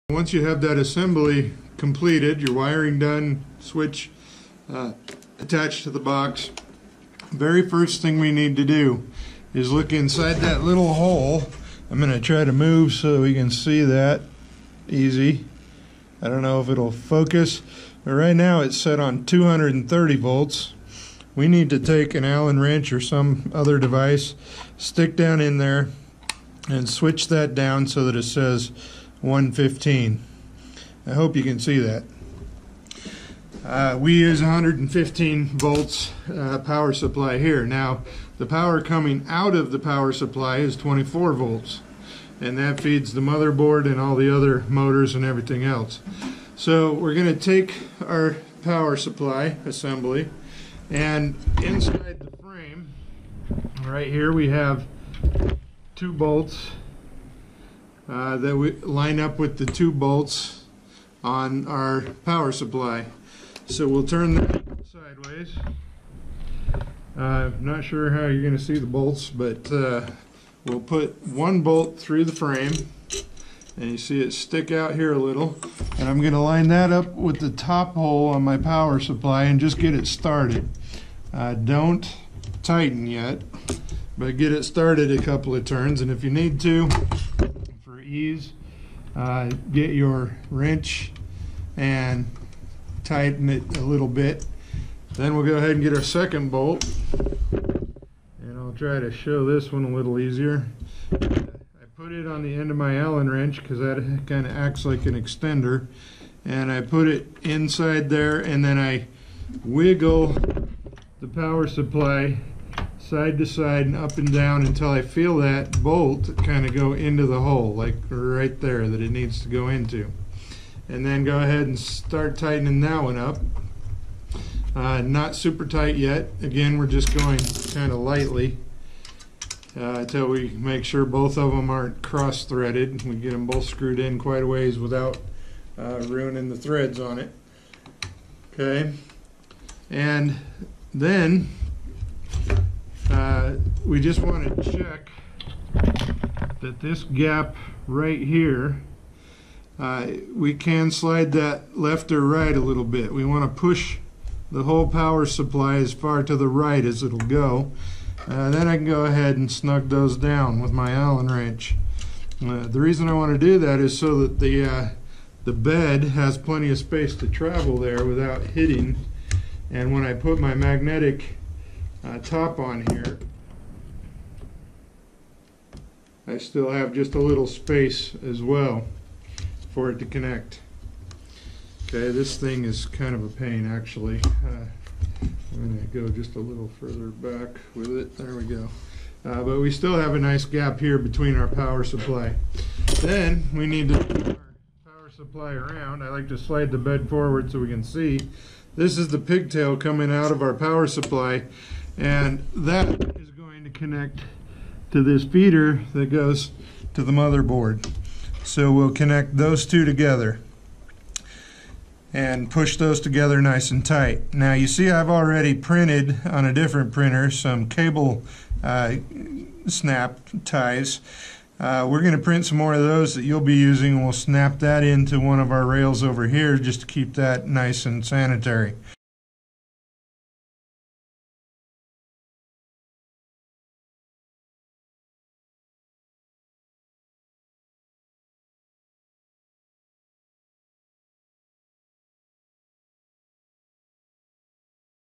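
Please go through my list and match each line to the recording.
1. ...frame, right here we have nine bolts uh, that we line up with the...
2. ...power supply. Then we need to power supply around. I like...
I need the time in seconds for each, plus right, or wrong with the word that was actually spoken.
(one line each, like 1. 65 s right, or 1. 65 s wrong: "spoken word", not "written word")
1. 52 s wrong: "two", not "nine"
2. 191 s right.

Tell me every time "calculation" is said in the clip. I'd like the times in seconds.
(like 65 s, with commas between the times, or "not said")
not said.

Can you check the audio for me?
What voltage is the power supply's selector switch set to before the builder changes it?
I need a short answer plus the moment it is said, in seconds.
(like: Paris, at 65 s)
230 volts, at 19 s.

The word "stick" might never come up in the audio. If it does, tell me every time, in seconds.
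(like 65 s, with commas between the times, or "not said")
24 s, 74 s.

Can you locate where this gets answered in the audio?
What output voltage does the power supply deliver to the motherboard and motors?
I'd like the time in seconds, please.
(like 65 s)
40 s.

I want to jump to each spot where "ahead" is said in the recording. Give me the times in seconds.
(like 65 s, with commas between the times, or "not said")
95 s, 121 s, 159 s.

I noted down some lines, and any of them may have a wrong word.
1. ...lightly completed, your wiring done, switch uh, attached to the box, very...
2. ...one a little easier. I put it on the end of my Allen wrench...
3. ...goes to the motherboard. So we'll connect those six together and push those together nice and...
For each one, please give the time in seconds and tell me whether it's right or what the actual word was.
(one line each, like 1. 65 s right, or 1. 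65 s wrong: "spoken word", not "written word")
1. 0 s wrong: "assembly", not "lightly"
2. 99 s right
3. 206 s wrong: "two", not "six".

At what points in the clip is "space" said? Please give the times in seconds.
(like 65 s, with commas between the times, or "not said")
166 s, 177 s.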